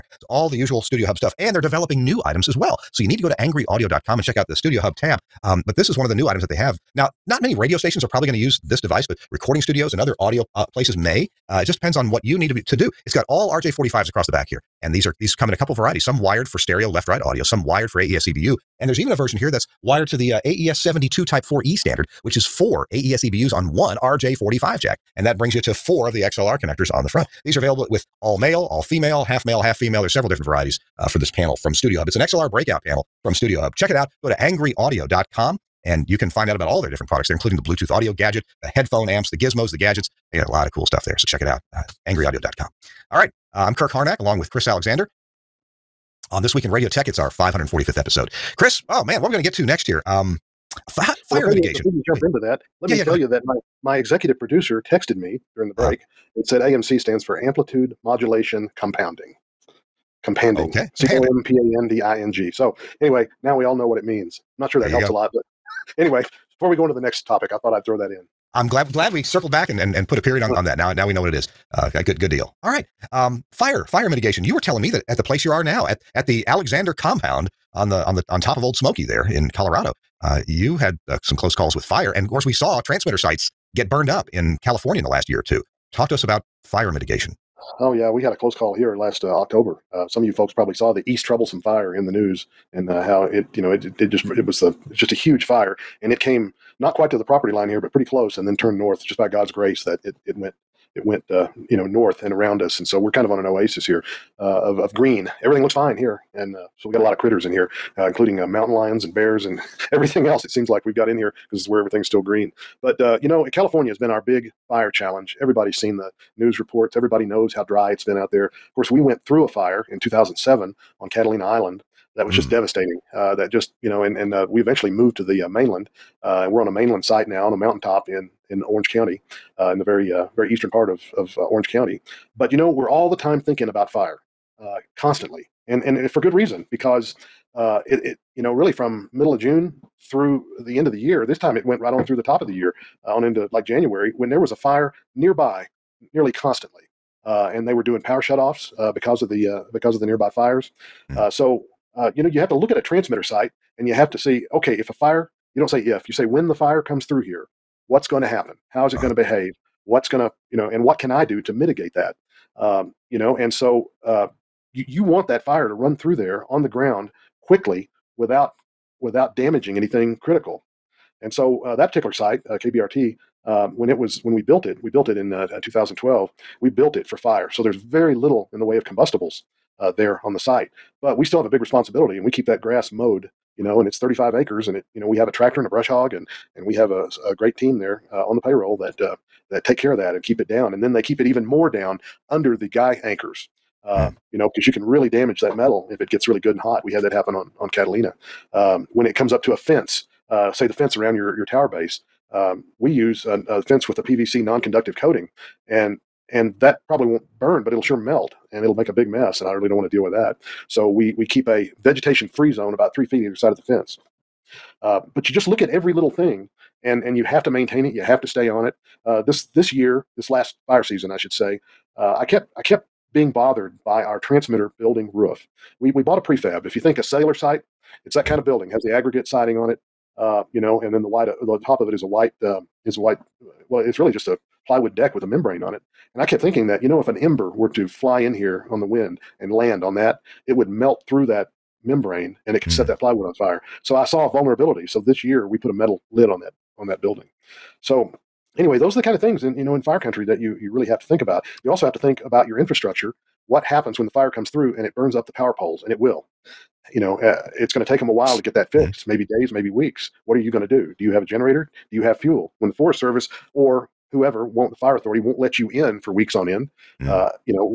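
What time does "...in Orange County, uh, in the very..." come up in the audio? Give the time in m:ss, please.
2:08.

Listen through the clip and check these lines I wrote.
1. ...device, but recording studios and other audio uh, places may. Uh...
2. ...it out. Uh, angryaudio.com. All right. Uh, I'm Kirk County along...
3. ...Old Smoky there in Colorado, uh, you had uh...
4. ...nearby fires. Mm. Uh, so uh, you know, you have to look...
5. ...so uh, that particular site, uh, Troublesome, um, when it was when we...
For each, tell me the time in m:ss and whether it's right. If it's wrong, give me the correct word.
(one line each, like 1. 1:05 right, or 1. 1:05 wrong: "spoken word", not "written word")
1. 0:08 right
2. 0:41 wrong: "Harnack", not "County"
3. 1:18 right
4. 2:30 right
5. 2:51 wrong: "KBRT", not "Troublesome".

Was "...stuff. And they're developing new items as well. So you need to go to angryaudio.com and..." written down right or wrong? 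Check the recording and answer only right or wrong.
right.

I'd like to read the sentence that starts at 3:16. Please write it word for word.
We had that happen on on Catalina.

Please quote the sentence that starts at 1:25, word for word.
Talk to us about fire mitigation.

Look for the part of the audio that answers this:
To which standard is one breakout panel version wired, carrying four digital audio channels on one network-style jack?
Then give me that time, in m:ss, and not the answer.
0:20.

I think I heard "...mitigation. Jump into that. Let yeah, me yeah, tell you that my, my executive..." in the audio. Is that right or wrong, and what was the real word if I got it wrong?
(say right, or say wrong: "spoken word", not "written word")
right.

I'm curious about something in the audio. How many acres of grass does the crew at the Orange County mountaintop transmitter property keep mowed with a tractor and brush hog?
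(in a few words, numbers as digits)
35.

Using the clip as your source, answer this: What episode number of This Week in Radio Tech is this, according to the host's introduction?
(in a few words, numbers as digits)
545th.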